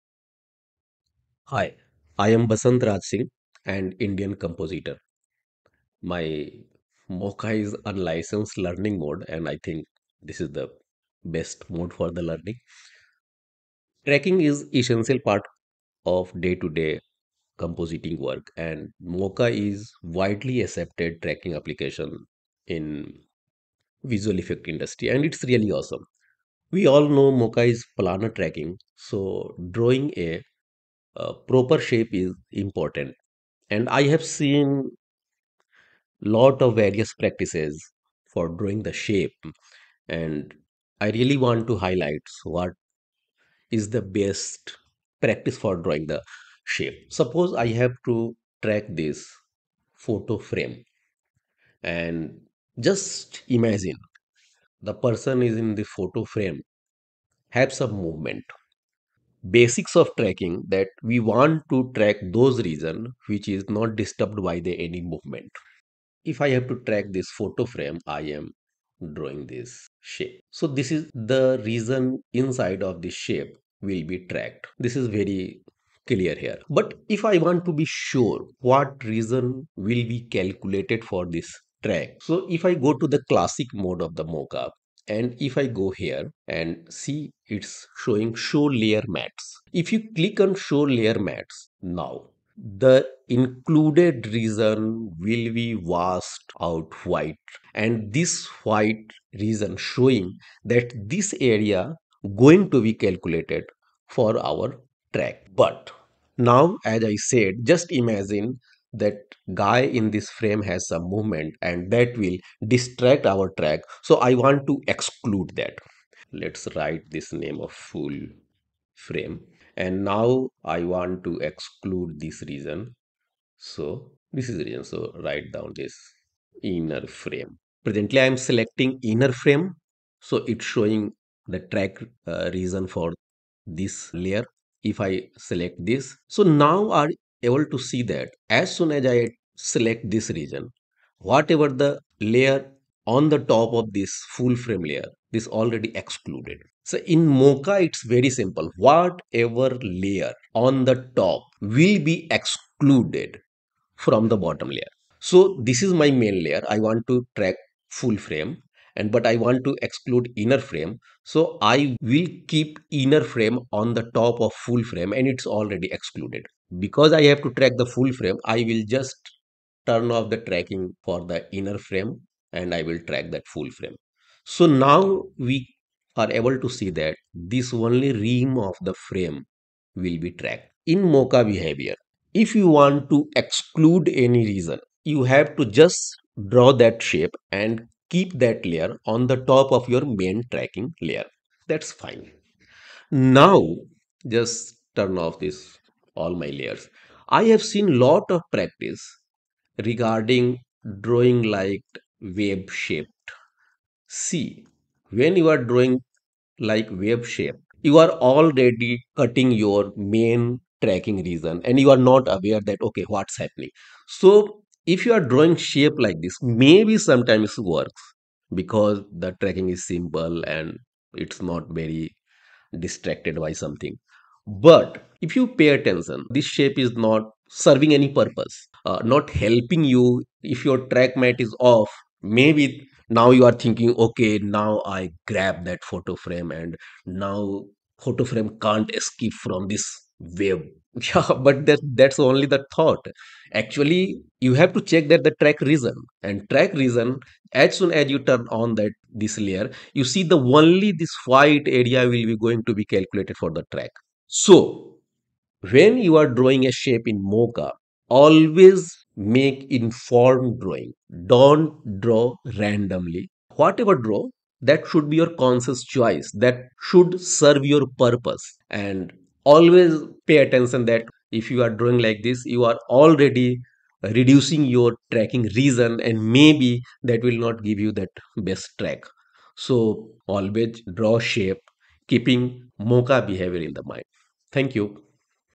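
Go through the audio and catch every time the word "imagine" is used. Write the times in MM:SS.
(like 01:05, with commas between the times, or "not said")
00:53, 01:47.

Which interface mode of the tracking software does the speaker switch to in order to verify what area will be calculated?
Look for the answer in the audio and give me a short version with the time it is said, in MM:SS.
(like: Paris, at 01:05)
Classic mode, at 01:23.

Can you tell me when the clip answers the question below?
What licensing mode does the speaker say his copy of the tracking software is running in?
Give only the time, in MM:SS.
00:07.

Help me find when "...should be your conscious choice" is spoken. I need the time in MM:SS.
04:24.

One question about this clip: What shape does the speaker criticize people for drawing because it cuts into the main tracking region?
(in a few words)
Wave shape.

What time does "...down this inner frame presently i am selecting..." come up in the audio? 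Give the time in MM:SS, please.
02:05.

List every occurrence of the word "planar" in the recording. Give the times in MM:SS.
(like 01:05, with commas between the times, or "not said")
00:27.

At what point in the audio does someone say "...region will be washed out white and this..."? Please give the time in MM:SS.
01:34.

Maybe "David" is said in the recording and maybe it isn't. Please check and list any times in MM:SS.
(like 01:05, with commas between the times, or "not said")
not said.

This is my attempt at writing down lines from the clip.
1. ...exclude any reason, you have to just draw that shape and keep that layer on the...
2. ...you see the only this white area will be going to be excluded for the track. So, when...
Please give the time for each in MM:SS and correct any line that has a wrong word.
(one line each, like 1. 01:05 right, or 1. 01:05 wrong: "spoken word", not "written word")
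1. 03:03 right
2. 04:09 wrong: "calculated", not "excluded".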